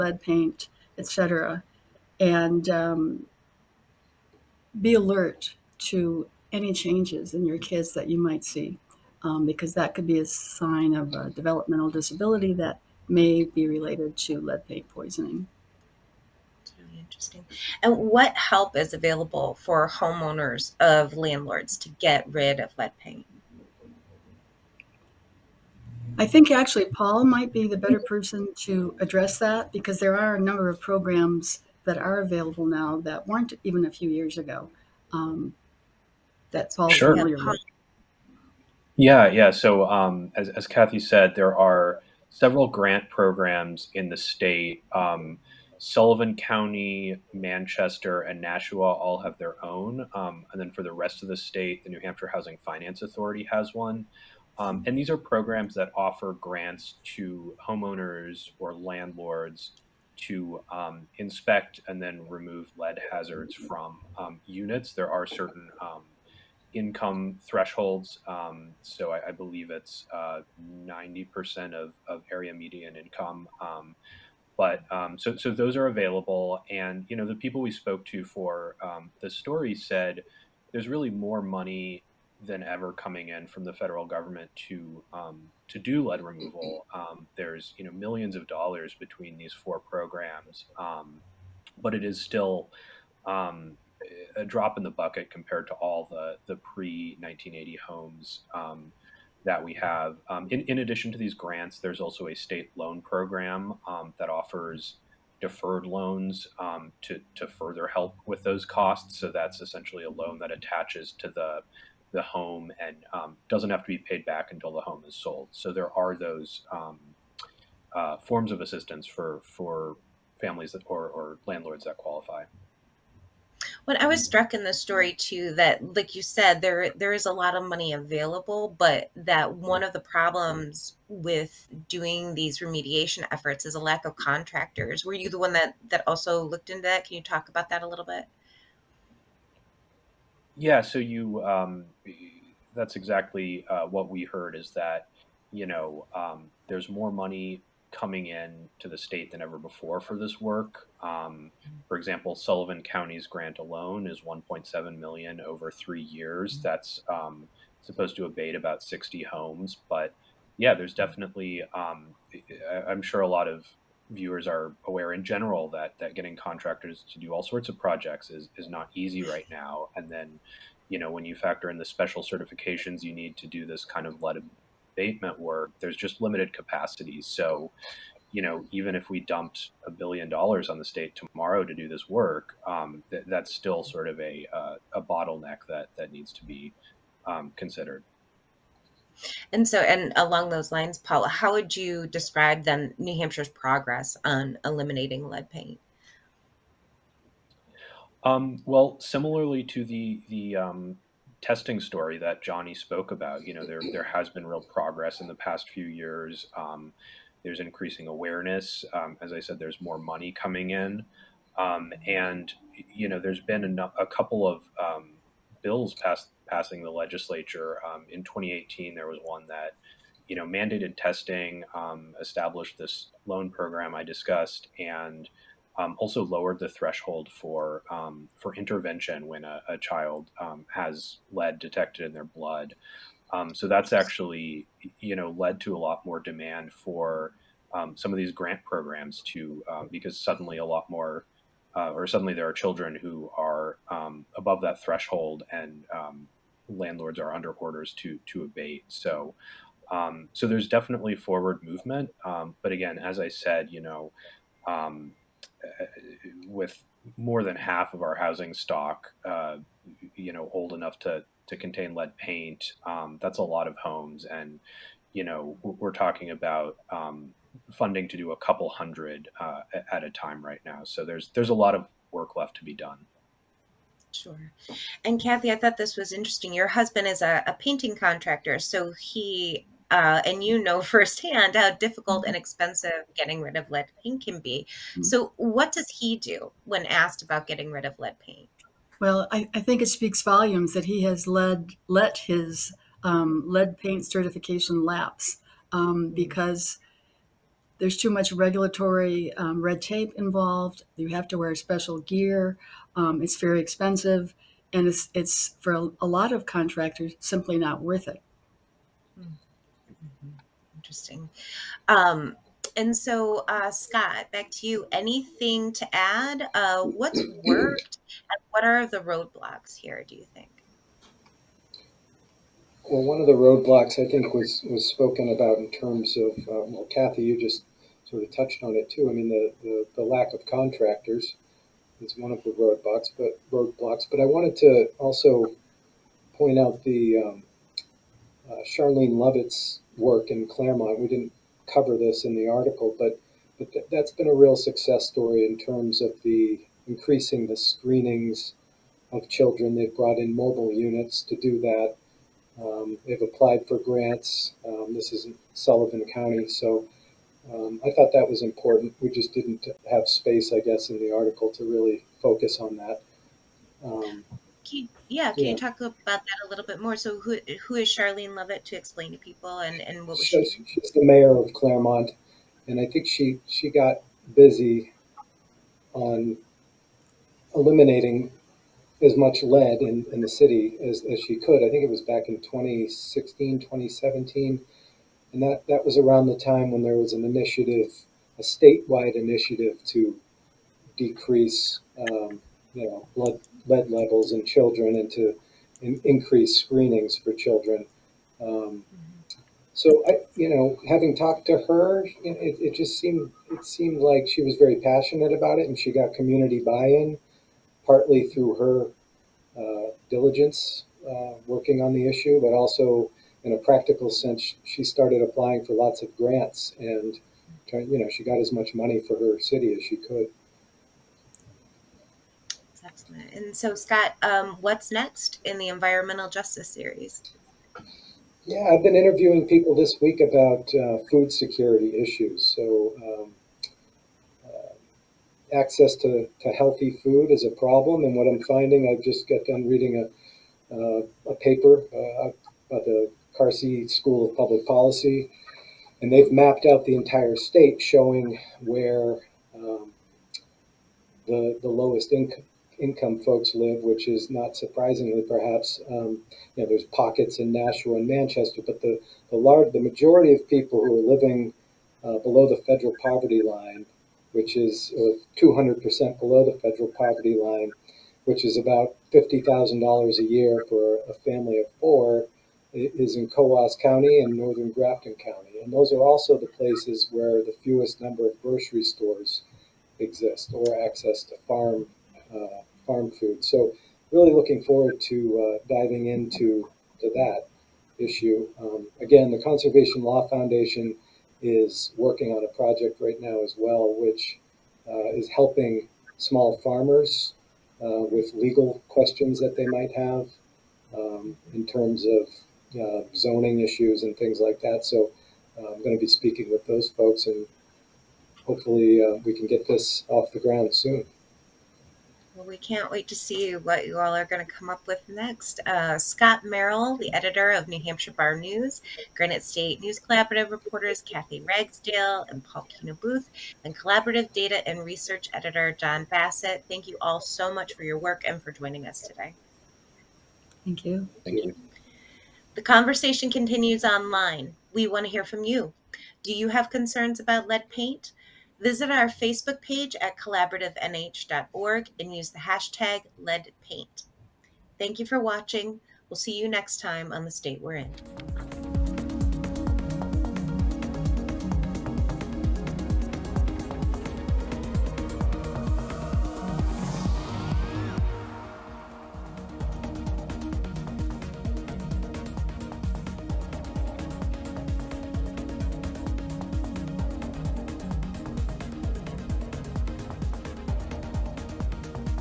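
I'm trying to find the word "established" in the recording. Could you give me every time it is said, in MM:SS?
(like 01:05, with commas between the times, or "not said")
03:42.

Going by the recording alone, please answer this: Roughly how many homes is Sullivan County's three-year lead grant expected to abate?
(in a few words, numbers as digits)
60.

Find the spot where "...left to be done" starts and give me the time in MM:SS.
04:32.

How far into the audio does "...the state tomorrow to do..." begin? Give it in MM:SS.
03:00.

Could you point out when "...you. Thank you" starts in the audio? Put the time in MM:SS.
08:50.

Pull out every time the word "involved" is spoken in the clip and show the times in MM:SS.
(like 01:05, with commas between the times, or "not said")
05:00.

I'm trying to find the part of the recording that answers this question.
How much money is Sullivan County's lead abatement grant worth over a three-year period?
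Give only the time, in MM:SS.
02:34.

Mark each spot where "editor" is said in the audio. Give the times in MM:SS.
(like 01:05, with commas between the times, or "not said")
08:37, 08:45.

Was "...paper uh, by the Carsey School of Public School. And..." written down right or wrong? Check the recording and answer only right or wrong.
wrong.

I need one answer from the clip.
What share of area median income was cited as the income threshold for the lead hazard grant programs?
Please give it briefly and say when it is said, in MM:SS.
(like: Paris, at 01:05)
90 percent, at 01:10.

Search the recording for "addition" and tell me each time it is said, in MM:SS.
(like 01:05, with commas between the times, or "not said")
01:40.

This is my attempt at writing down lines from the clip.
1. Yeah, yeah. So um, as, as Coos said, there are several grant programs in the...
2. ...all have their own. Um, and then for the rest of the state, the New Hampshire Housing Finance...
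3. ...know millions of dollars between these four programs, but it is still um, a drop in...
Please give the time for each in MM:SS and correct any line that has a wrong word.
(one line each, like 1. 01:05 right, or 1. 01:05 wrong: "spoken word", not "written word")
1. 00:38 wrong: "Kathy", not "Coos"
2. 00:48 right
3. 01:27 right.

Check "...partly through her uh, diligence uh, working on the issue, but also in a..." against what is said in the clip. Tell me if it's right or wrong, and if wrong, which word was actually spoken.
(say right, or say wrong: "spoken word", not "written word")
right.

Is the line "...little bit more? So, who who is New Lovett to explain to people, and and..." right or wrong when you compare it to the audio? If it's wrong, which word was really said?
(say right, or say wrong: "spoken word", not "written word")
wrong: "Charlene", not "New".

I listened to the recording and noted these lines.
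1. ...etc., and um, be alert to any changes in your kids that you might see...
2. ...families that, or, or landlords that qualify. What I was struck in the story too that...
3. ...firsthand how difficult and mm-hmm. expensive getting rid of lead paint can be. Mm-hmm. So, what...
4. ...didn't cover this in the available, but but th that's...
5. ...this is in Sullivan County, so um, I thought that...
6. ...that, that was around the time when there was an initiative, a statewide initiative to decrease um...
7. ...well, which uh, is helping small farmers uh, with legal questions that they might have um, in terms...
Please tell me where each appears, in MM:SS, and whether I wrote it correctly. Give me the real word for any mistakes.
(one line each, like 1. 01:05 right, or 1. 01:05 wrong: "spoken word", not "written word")
1. 00:00 right
2. 02:00 right
3. 04:40 right
4. 05:41 wrong: "article", not "available"
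5. 05:54 right
6. 06:25 right
7. 08:13 right.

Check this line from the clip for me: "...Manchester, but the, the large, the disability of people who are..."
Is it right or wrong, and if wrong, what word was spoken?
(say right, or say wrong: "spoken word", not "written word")
wrong: "majority", not "disability".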